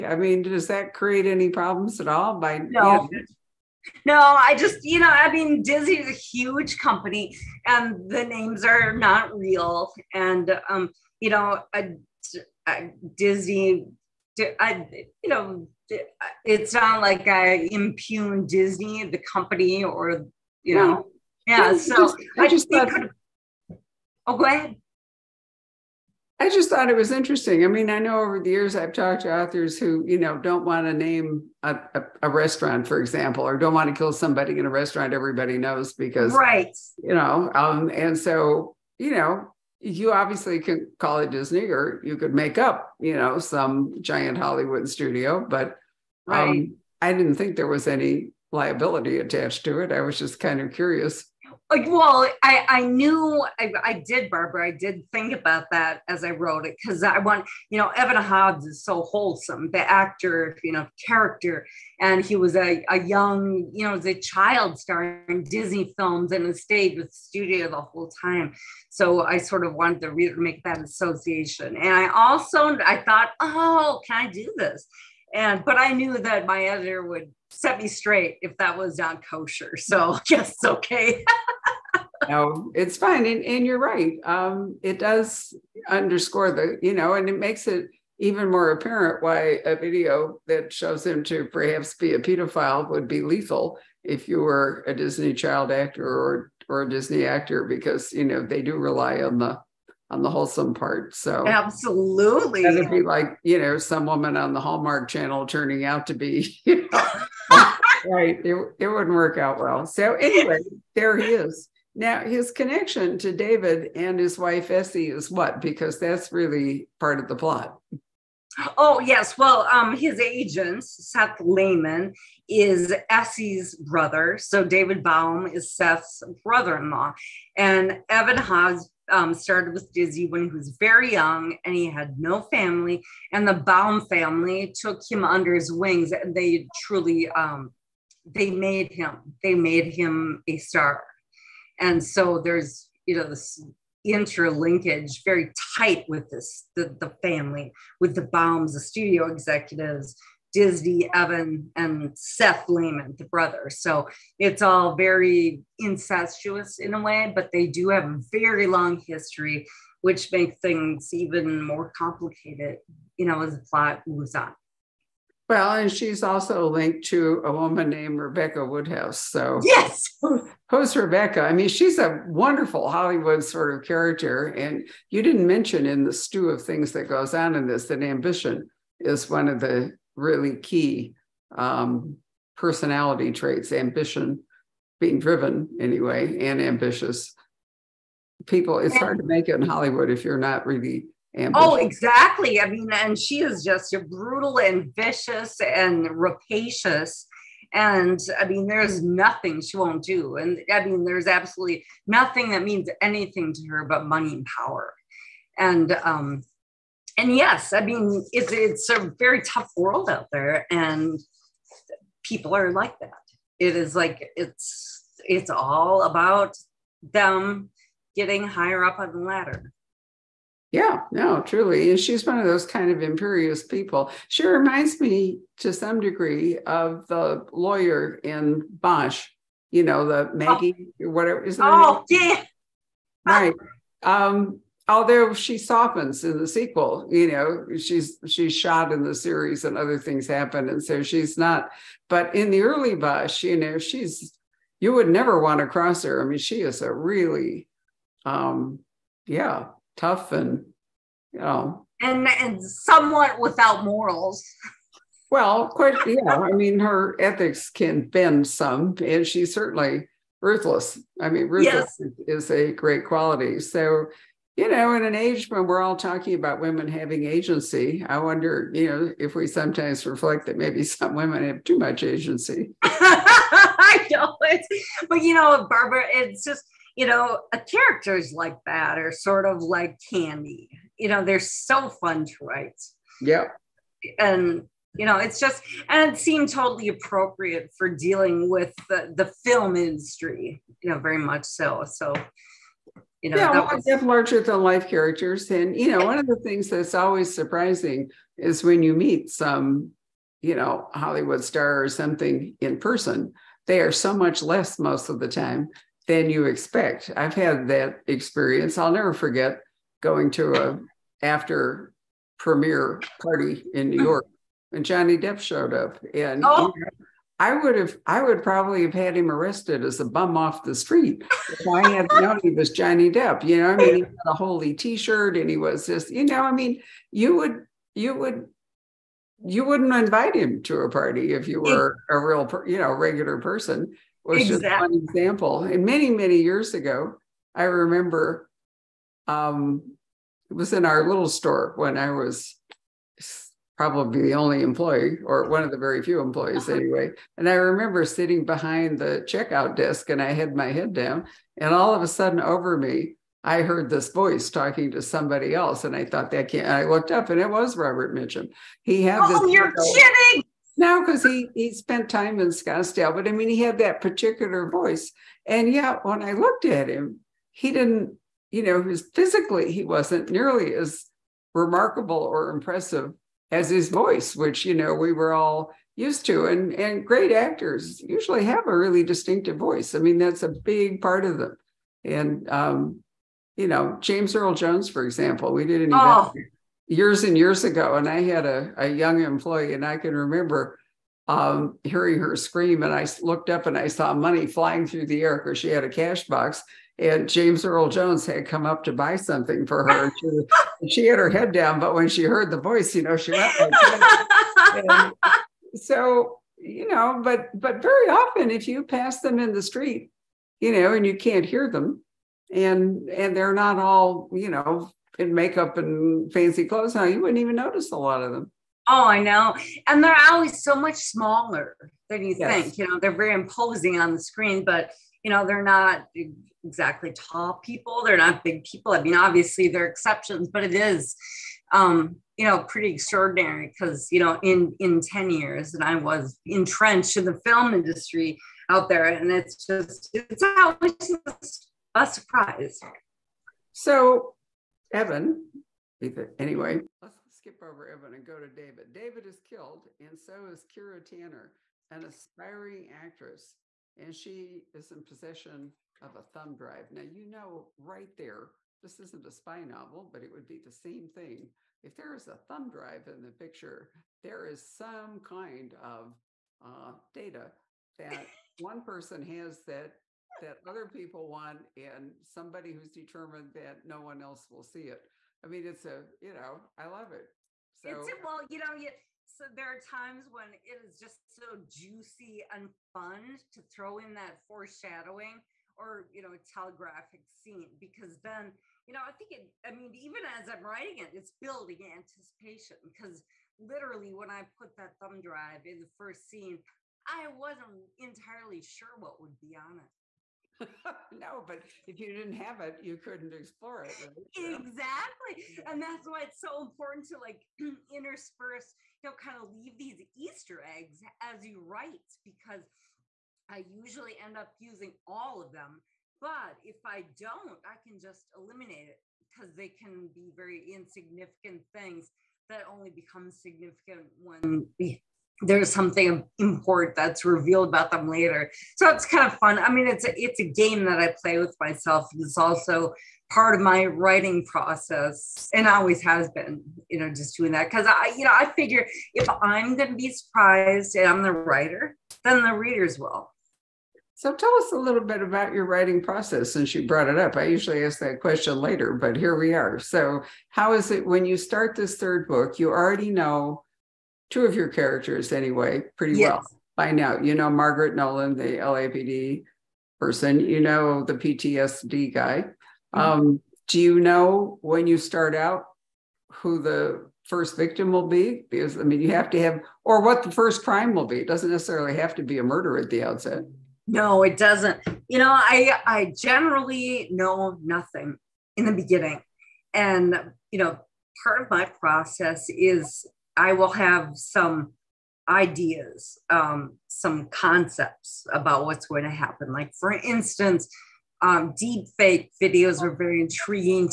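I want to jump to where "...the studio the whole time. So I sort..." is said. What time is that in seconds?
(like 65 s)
67 s.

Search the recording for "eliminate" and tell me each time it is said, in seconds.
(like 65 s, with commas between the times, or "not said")
518 s.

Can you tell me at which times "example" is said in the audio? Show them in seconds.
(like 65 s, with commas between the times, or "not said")
32 s, 335 s, 385 s.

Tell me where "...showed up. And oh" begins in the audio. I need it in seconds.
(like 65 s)
315 s.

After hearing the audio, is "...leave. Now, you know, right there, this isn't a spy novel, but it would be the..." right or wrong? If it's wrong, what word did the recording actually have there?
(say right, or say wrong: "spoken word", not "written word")
wrong: "drive", not "leave".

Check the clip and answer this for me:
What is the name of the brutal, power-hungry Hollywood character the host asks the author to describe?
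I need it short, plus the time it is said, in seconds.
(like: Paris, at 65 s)
Rebecca Woodhouse, at 168 s.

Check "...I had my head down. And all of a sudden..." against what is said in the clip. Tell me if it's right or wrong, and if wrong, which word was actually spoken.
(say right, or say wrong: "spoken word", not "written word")
right.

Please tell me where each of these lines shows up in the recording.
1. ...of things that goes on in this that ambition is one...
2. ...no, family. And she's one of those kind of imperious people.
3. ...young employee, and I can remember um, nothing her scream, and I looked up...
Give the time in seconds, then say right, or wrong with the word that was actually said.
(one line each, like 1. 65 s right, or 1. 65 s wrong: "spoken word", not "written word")
1. 176 s right
2. 221 s wrong: "truly", not "family"
3. 388 s wrong: "hearing", not "nothing".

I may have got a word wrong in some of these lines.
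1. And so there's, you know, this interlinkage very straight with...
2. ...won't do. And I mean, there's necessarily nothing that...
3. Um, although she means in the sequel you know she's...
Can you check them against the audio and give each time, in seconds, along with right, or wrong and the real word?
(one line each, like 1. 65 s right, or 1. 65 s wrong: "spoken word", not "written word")
1. 141 s wrong: "tight", not "straight"
2. 199 s wrong: "absolutely", not "necessarily"
3. 234 s wrong: "softens", not "means".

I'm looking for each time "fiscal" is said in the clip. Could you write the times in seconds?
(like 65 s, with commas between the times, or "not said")
not said.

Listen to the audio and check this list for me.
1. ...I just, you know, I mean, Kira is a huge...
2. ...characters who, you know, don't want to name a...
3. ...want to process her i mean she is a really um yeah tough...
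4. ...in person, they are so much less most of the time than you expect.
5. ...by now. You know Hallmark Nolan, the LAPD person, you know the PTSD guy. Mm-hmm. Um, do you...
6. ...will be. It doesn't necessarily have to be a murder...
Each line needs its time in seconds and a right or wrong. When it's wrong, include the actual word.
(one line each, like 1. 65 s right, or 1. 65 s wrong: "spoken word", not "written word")
1. 4 s wrong: "Disney", not "Kira"
2. 29 s wrong: "authors", not "characters"
3. 245 s wrong: "cross", not "process"
4. 302 s right
5. 556 s wrong: "Margaret", not "Hallmark"
6. 570 s right.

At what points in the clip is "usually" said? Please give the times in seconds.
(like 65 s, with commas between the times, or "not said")
378 s, 513 s, 547 s.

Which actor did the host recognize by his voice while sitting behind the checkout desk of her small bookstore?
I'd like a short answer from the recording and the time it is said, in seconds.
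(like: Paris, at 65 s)
Robert Mitchum, at 357 s.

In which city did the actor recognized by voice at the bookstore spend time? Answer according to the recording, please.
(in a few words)
Scottsdale.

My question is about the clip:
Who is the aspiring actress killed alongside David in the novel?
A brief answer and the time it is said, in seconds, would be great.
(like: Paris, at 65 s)
Kira Tanner, at 450 s.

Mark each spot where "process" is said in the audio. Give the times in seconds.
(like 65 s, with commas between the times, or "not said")
534 s, 546 s, 581 s.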